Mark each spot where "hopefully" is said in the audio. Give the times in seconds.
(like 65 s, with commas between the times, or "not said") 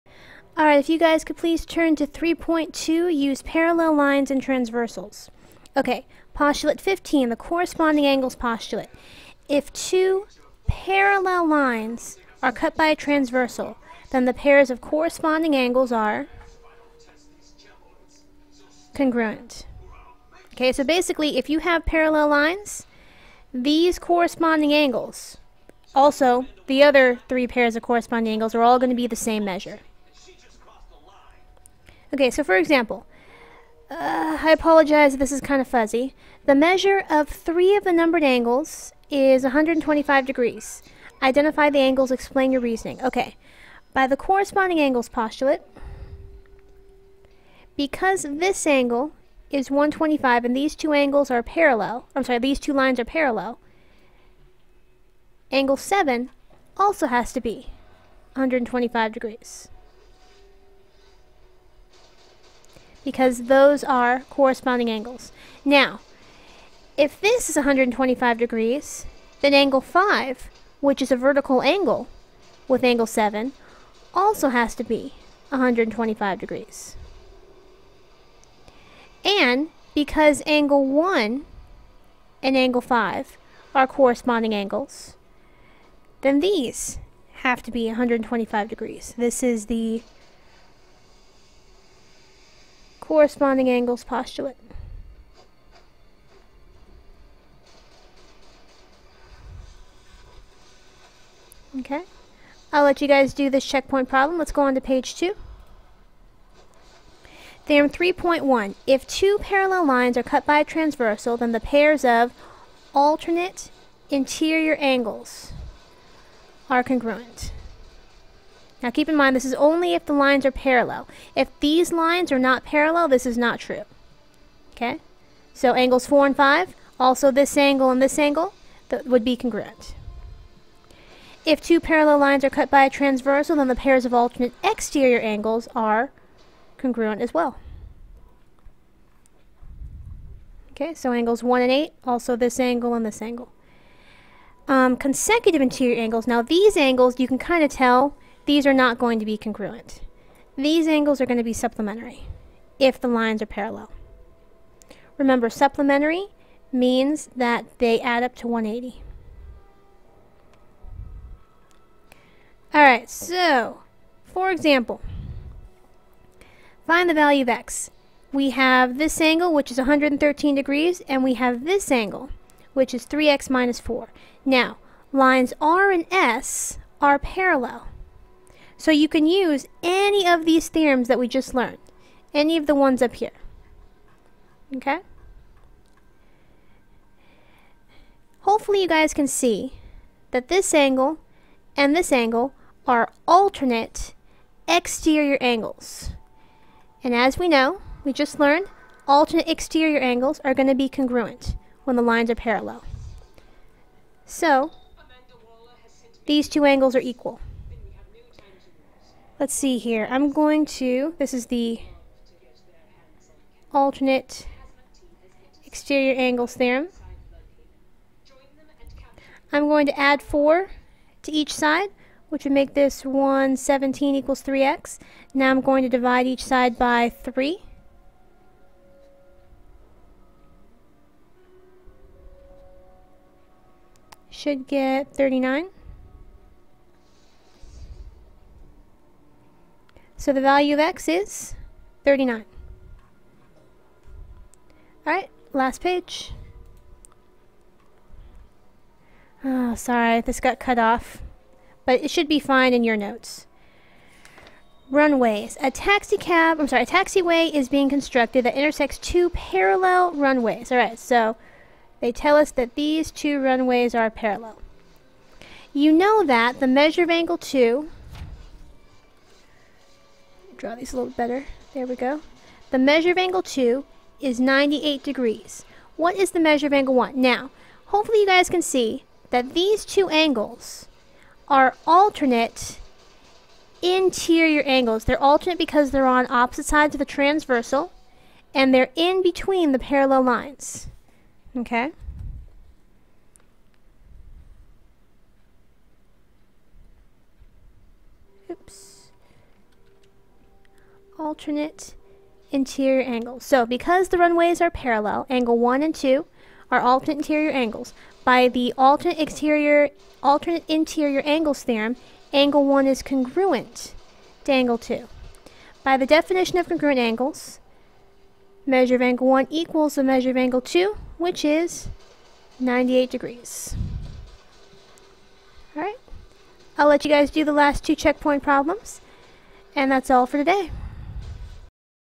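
188 s, 277 s.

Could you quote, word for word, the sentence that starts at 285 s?
They're alternate because they're on opposite sides of the transversal and they're in between the parallel lines.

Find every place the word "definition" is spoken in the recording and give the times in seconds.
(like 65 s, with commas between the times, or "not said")
316 s.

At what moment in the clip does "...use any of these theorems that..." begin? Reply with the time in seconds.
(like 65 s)
179 s.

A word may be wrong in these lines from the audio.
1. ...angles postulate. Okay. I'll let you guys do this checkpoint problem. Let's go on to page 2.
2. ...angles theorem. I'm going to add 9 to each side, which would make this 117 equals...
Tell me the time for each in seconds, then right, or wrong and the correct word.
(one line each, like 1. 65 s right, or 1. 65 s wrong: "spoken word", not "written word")
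1. 93 s right
2. 216 s wrong: "4", not "9".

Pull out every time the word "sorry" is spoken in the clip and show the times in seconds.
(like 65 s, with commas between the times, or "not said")
52 s, 249 s, 256 s.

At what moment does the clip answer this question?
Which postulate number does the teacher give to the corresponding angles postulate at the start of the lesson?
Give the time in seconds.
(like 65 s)
6 s.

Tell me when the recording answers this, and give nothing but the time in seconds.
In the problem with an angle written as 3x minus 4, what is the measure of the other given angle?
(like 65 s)
169 s.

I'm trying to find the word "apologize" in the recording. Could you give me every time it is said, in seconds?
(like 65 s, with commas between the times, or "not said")
34 s.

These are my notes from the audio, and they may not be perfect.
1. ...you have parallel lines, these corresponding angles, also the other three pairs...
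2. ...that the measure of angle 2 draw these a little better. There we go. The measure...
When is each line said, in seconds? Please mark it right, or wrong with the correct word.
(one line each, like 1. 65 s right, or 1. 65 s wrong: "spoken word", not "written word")
1. 21 s right
2. 266 s right.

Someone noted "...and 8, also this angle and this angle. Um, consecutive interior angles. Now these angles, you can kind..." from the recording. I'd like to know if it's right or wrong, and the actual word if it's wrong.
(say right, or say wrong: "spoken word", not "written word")
right.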